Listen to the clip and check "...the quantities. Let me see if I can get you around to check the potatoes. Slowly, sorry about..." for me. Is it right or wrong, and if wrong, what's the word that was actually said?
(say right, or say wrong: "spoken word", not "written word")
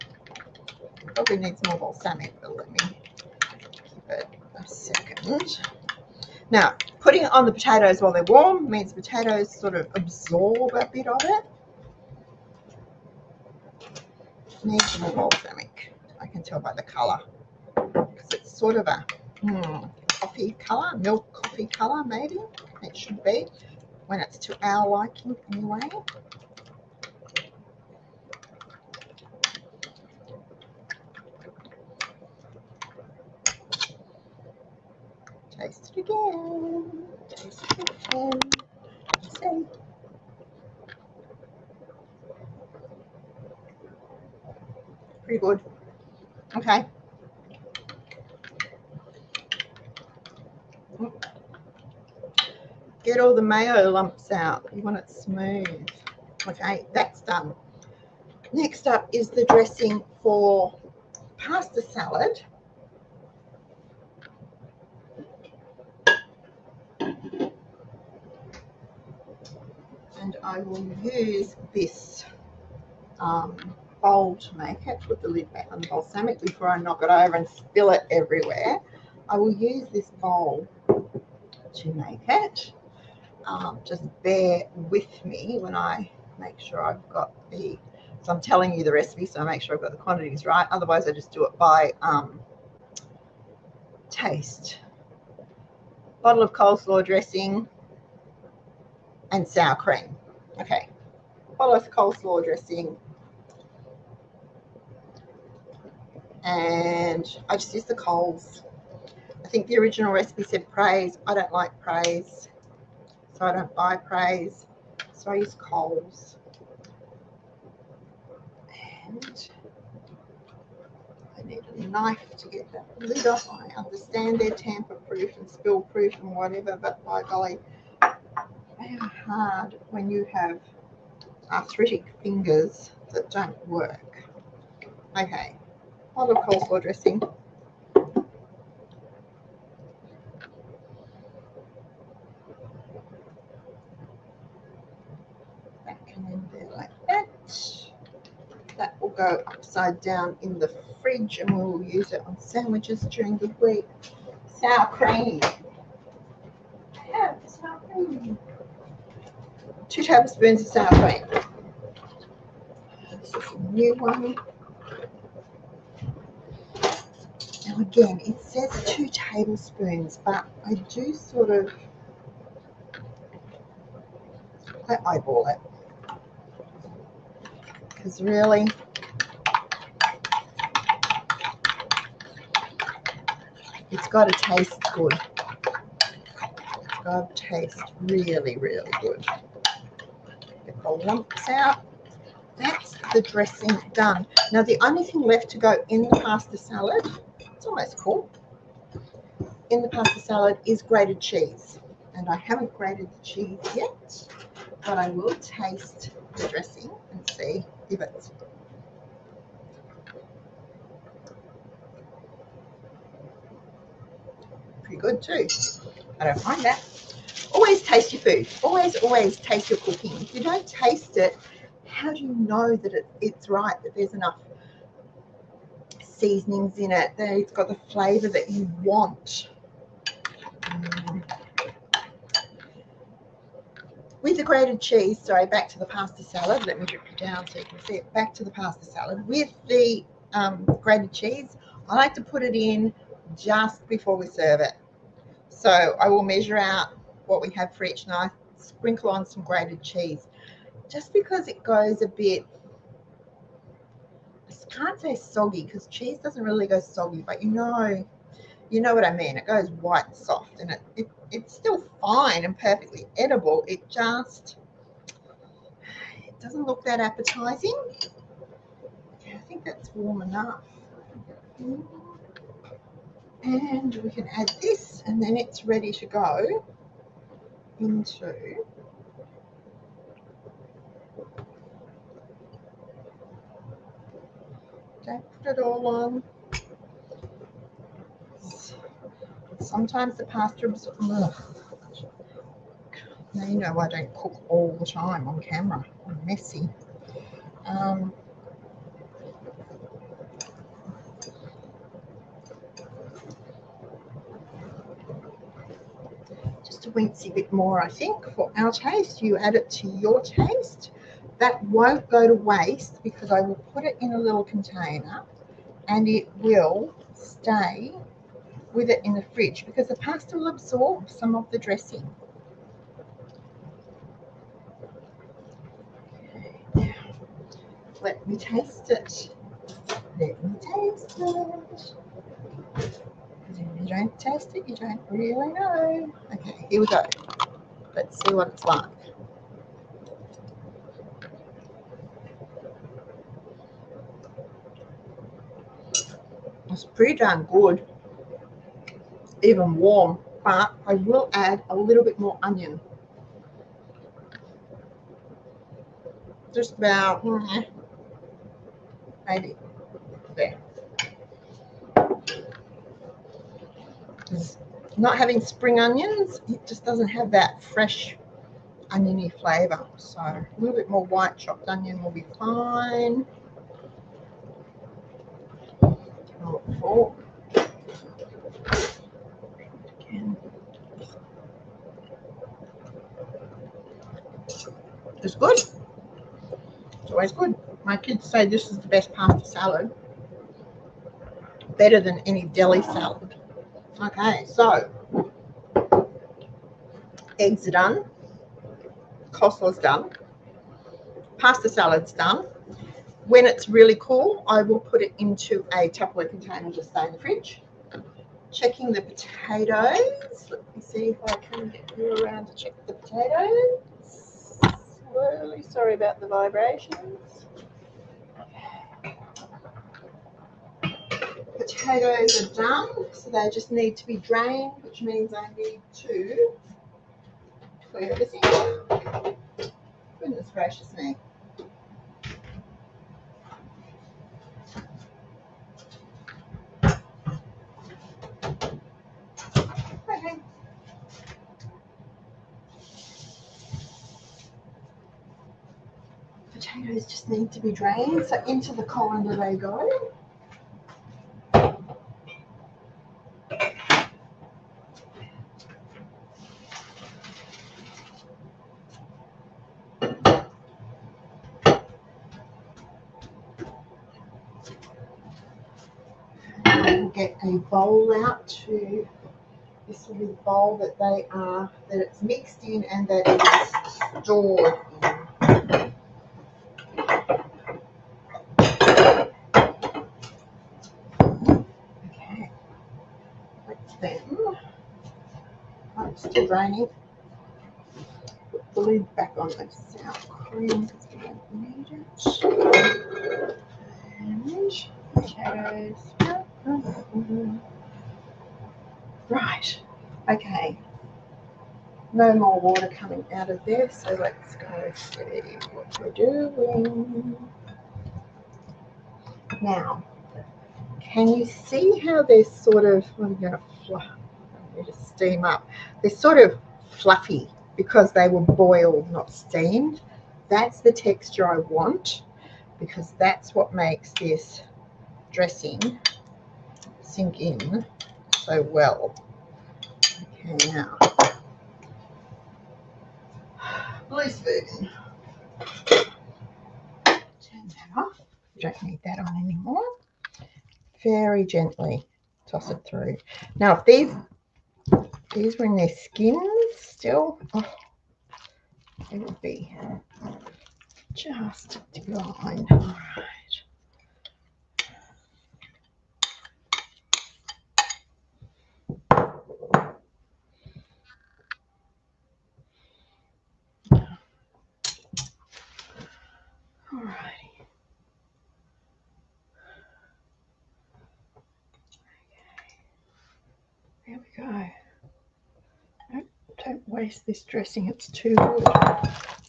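wrong: "potatoes", not "quantities".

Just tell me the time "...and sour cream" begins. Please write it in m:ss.
1:39.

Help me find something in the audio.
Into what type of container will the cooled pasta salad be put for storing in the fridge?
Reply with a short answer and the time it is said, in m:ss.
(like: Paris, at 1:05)
Tupperware, at 6:45.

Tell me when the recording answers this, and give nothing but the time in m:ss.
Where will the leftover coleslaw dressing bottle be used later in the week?
2:32.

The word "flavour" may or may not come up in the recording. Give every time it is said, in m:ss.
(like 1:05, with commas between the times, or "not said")
3:47, 6:09.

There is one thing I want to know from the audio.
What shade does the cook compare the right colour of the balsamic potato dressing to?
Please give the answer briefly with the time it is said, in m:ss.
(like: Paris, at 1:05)
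milk coffee, at 0:20.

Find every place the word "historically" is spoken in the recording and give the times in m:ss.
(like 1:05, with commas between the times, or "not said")
not said.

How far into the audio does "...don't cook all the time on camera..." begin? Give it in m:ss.
4:53.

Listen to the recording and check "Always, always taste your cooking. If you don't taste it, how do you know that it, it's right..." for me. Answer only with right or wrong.
right.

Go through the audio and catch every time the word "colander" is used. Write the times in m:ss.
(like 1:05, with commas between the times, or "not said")
7:28.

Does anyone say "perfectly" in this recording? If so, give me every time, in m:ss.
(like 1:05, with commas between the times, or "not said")
4:22.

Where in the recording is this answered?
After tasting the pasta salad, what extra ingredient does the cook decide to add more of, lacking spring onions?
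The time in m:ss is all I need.
6:11.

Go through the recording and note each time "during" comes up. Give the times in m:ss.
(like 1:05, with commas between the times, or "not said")
2:33.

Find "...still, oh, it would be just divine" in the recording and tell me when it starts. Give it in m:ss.
9:06.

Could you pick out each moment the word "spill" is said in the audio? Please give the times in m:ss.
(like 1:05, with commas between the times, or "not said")
1:17, 2:05.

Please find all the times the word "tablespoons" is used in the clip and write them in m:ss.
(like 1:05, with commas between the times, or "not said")
2:40, 2:49.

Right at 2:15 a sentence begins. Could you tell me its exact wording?
Okay, a lot of coleslaw dressing.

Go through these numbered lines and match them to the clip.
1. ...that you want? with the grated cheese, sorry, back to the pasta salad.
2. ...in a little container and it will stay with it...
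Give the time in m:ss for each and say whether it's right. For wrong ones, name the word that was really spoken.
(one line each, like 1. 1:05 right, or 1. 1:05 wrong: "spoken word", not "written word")
1. 3:48 right
2. 5:14 right.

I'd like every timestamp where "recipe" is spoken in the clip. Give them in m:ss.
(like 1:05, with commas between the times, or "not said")
1:28, 1:50.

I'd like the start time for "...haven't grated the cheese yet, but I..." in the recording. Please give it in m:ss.
3:22.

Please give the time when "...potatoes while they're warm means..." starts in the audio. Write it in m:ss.
0:07.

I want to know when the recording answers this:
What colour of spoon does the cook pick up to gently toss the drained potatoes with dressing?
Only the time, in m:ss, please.
8:54.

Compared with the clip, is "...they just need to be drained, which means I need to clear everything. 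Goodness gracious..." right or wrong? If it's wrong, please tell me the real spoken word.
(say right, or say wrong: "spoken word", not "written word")
right.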